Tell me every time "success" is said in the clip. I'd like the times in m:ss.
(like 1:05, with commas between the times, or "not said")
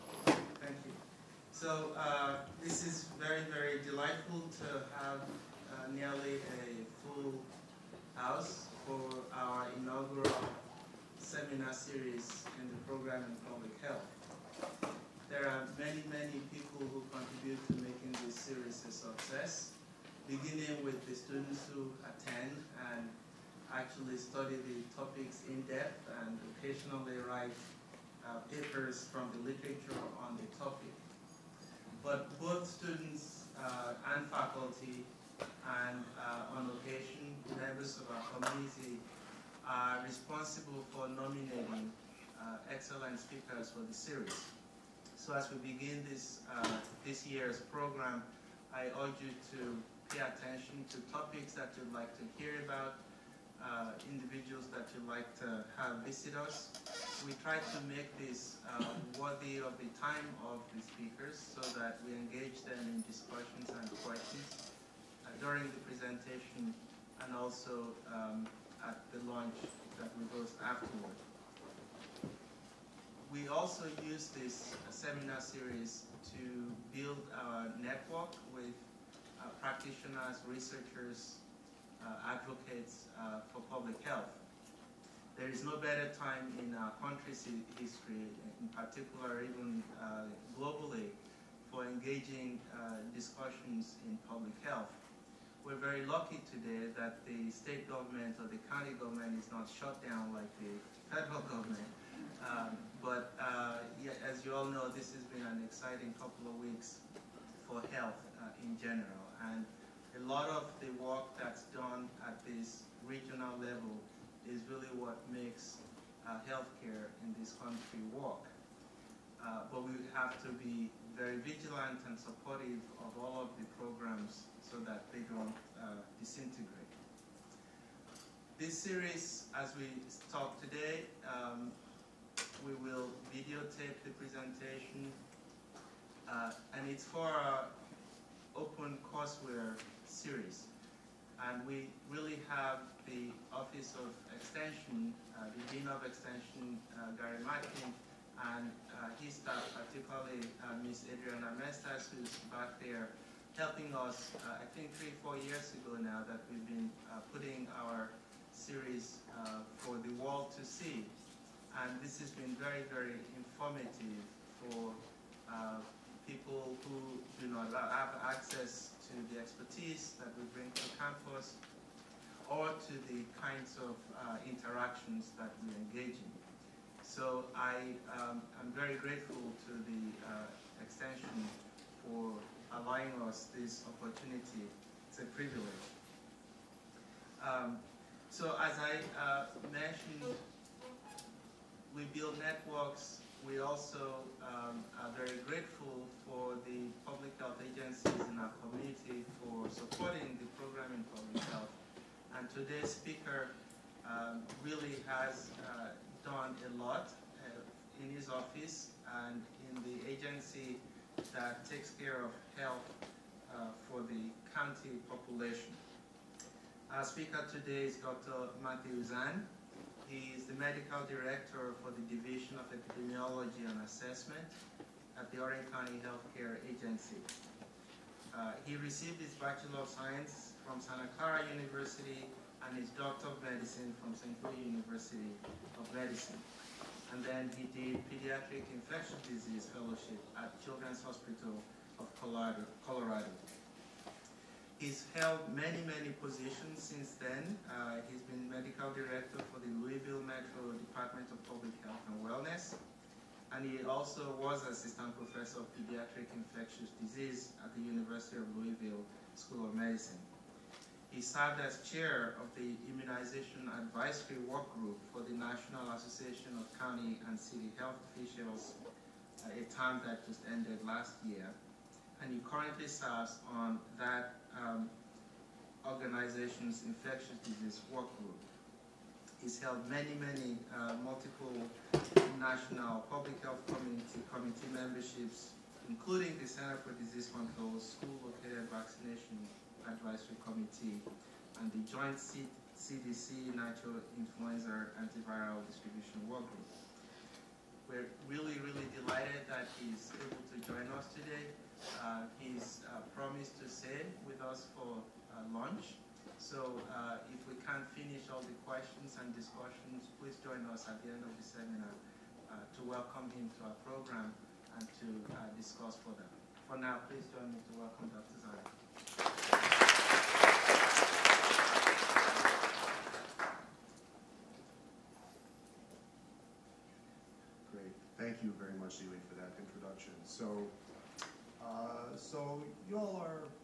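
0:18.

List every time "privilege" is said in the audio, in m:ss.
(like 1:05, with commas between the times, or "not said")
3:05.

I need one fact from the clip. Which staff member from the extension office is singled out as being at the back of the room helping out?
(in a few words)
Adriana Mestas.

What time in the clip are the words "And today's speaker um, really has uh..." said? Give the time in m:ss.
3:22.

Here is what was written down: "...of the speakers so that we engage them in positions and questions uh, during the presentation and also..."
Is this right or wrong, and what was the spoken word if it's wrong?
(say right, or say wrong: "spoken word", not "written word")
wrong: "discussions", not "positions".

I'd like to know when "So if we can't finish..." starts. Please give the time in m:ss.
5:06.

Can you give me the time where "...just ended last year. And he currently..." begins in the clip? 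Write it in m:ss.
4:30.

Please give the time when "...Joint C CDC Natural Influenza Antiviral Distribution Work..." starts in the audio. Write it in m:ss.
4:51.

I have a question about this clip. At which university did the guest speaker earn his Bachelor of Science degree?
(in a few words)
Santa Clara University.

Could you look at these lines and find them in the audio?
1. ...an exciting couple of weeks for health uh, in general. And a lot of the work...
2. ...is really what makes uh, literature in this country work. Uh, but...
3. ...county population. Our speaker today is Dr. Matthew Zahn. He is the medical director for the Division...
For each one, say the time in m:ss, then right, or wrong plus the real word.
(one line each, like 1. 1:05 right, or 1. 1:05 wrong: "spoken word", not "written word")
1. 1:45 right
2. 1:54 wrong: "healthcare", not "literature"
3. 3:34 right.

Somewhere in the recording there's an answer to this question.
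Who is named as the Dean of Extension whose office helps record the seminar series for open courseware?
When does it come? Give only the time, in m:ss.
2:27.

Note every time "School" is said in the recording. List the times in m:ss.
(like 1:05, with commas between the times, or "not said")
4:19, 4:47.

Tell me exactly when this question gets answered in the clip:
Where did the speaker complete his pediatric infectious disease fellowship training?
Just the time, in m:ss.
4:00.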